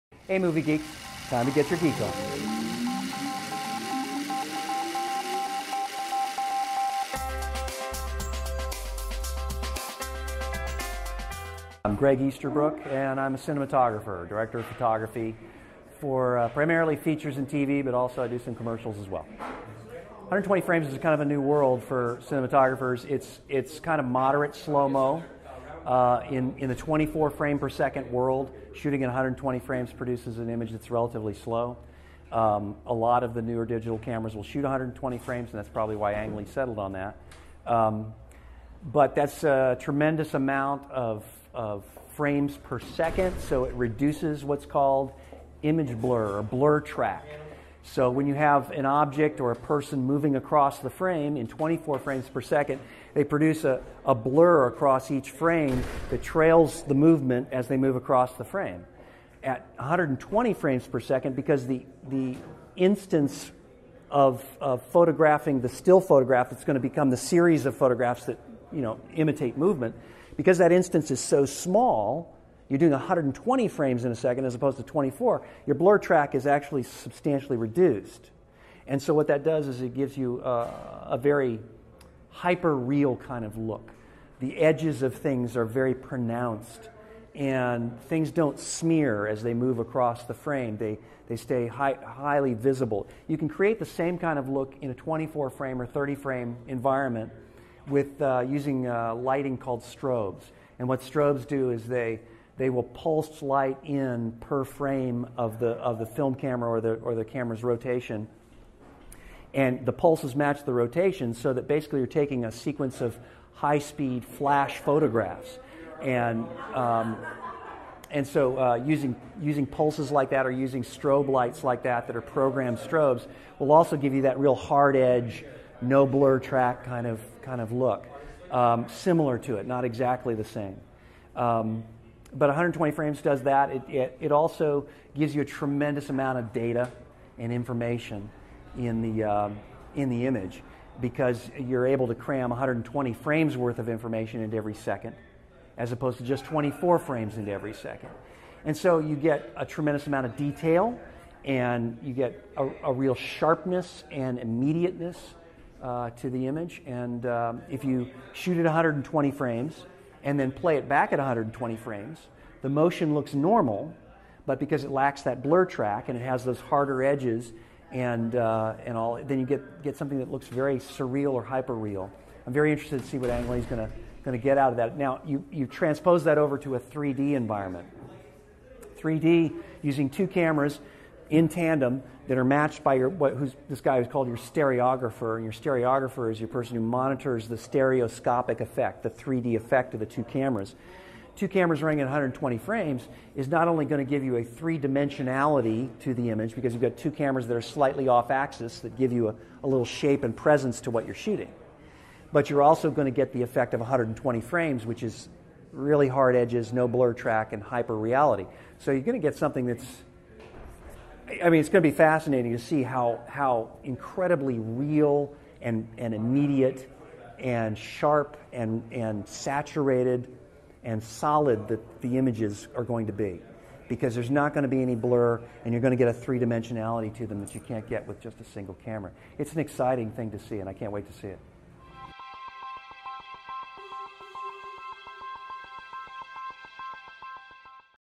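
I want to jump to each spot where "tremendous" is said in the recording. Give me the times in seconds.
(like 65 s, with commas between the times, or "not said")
39 s, 135 s, 149 s.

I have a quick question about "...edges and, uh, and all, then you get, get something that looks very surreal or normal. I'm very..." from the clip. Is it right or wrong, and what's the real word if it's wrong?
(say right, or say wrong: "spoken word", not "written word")
wrong: "hyperreal", not "normal".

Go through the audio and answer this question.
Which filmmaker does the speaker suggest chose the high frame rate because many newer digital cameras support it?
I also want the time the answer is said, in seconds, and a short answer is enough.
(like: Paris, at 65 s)
Ang Lee, at 36 s.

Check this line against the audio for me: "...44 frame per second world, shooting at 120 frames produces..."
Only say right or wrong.
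wrong.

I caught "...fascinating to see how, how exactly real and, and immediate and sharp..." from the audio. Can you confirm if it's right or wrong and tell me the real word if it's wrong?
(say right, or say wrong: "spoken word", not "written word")
wrong: "incredibly", not "exactly".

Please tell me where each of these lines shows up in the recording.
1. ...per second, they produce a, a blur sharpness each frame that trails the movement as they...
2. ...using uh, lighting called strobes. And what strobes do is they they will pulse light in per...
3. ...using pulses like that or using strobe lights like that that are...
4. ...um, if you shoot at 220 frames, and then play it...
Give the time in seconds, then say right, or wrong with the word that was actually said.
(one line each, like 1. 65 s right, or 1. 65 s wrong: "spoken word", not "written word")
1. 52 s wrong: "across", not "sharpness"
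2. 98 s right
3. 119 s right
4. 157 s wrong: "120", not "220".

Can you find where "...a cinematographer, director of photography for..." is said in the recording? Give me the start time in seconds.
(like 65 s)
13 s.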